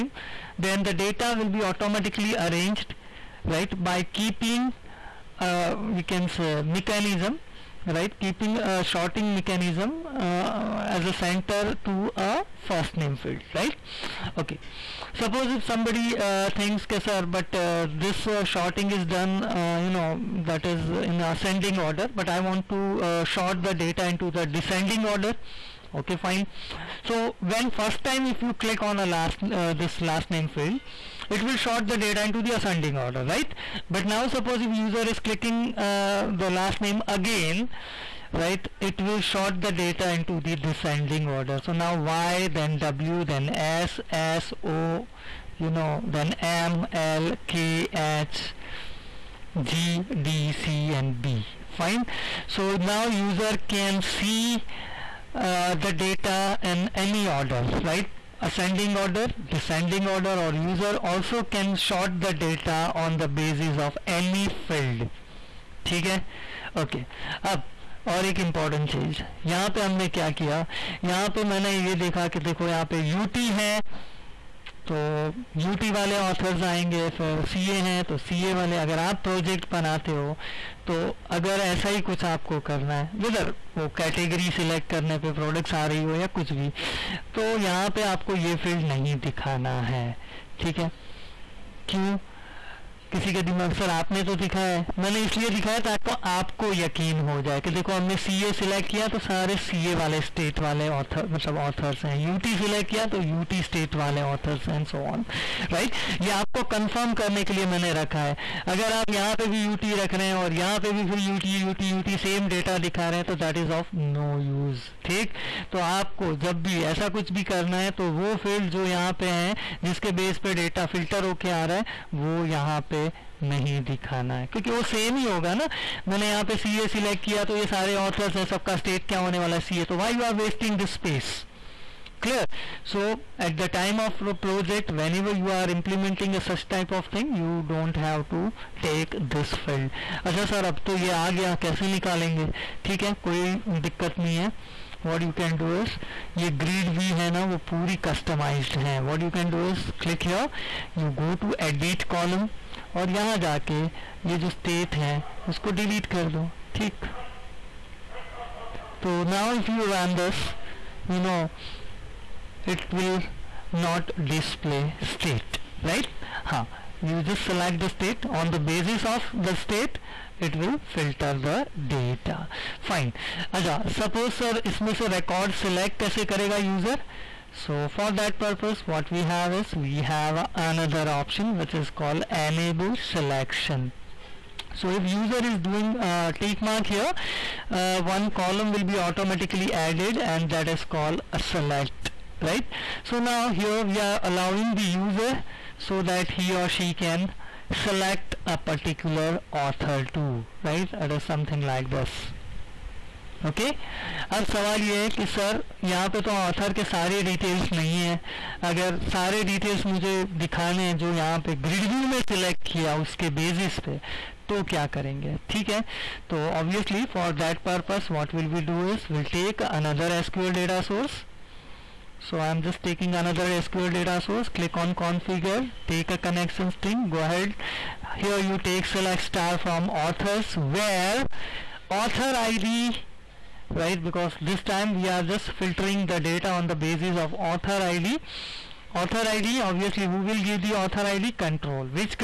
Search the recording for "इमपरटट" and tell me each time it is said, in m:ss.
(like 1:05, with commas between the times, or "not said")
1:08.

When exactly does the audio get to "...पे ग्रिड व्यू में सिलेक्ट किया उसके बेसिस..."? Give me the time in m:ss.
3:31.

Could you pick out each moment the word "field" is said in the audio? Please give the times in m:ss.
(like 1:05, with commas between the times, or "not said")
0:13, 0:30, 1:04.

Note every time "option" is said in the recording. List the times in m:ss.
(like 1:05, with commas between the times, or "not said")
3:01.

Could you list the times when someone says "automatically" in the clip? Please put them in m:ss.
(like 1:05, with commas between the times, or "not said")
0:01, 3:08.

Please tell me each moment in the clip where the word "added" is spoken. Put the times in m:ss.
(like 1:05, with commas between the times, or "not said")
3:09.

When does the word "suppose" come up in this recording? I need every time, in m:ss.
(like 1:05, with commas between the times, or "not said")
0:15, 0:34.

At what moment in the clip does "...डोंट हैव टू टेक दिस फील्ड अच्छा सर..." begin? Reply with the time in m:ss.
2:17.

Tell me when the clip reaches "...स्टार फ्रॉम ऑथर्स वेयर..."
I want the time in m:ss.
3:49.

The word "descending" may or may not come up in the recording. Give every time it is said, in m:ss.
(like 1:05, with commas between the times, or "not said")
0:24, 0:40, 0:59.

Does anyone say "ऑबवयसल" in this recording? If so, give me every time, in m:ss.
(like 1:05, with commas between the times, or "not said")
3:36.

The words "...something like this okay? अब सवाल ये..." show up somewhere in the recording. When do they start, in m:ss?
3:21.